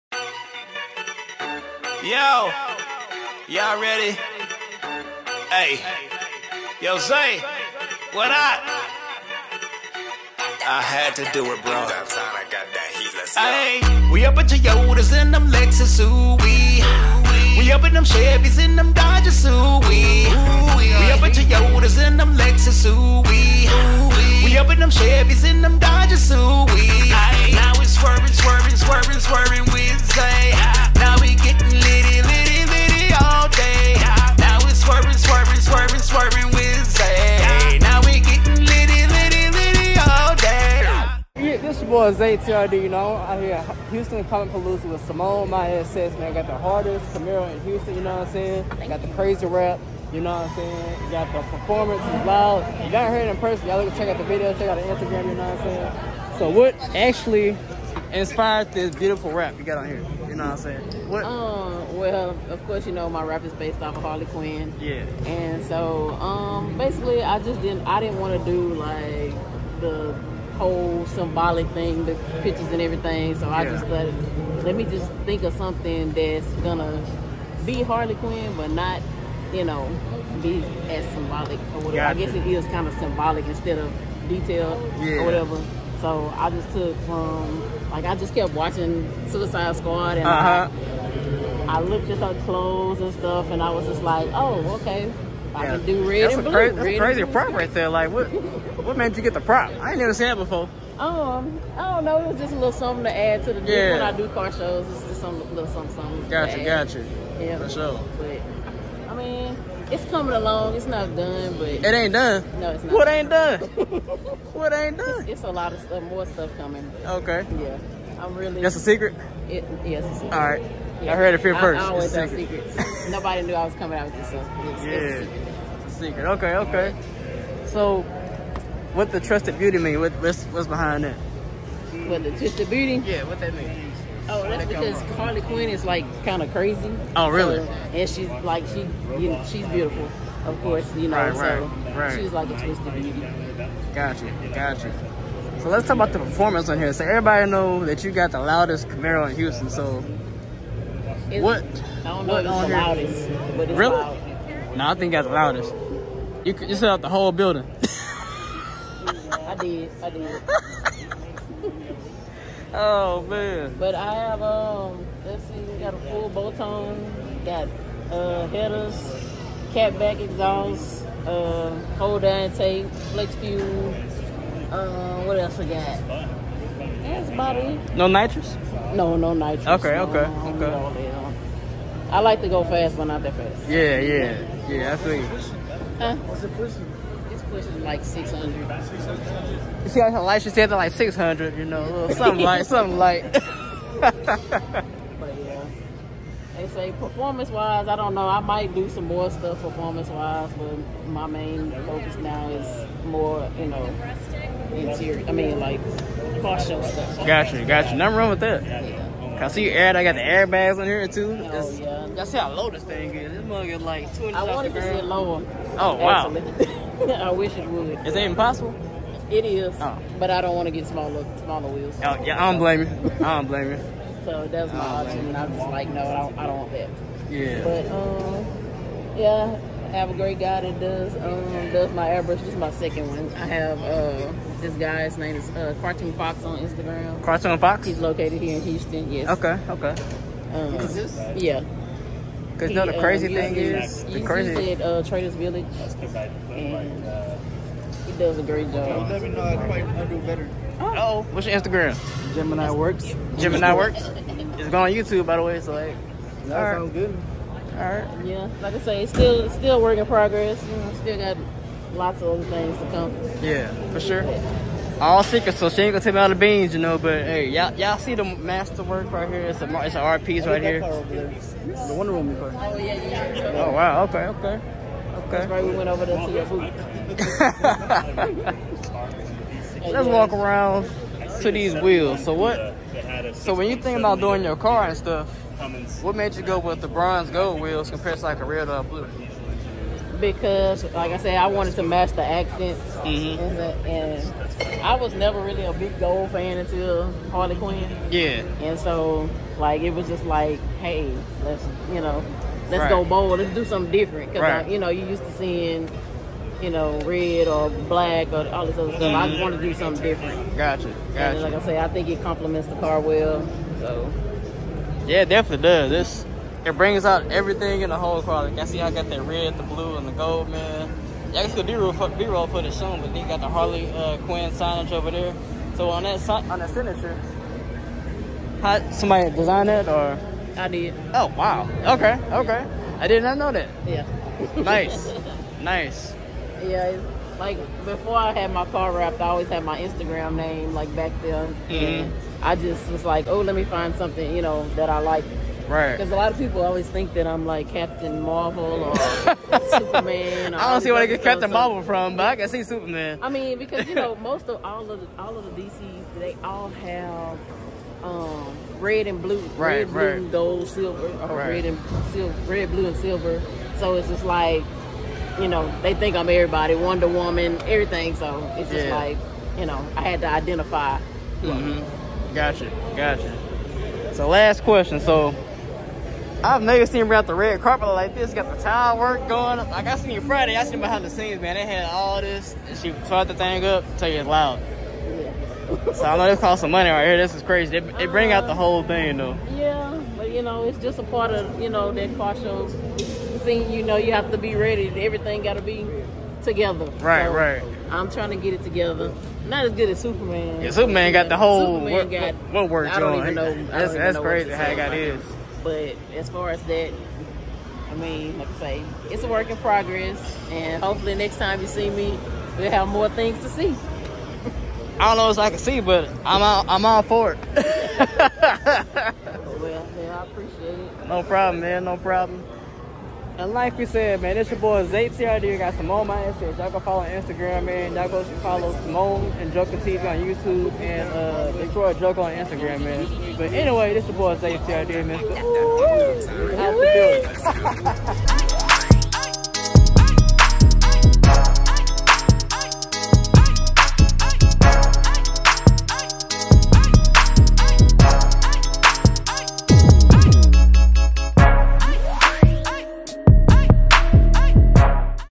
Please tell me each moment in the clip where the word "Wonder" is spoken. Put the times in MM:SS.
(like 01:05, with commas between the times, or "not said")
04:31, 06:06.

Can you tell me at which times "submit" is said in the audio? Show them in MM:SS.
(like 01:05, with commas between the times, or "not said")
not said.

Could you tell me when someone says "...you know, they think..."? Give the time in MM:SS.
06:05.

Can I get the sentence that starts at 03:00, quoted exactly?
No, I like to go fast, but not that fast.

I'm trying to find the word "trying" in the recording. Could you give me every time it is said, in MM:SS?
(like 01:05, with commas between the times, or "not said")
06:38.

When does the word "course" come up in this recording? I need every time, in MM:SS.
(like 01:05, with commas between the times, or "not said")
01:02, 02:20.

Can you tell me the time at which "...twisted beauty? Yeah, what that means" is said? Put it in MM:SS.
02:12.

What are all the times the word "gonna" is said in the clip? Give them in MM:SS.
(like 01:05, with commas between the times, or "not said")
01:16, 04:25.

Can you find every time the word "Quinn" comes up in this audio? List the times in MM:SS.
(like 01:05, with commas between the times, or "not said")
01:04, 01:18, 02:15, 04:57, 05:24.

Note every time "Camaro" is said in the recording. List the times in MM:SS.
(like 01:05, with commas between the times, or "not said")
00:47, 02:28.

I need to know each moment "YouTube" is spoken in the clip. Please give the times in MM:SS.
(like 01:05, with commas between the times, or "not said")
04:14, 07:10.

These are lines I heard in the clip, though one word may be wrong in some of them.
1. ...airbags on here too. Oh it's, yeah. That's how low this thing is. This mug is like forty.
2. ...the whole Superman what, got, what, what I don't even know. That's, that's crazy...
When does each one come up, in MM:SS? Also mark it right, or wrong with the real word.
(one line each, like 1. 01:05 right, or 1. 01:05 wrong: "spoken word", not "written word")
1. 03:30 wrong: "twenty", not "forty"
2. 06:41 right.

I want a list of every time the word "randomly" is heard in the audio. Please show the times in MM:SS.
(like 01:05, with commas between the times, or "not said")
not said.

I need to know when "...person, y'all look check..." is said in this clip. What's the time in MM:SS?
00:53.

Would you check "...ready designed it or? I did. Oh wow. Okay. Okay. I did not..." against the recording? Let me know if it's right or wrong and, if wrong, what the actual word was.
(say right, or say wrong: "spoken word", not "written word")
wrong: "somebody", not "ready".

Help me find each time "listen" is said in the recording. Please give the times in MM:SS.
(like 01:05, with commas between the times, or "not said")
not said.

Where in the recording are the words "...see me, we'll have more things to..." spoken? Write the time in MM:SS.
06:51.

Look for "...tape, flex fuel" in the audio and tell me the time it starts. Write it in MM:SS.
02:52.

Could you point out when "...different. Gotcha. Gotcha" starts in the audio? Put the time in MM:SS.
05:10.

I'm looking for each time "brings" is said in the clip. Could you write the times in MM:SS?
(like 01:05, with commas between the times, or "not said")
05:16, 06:28.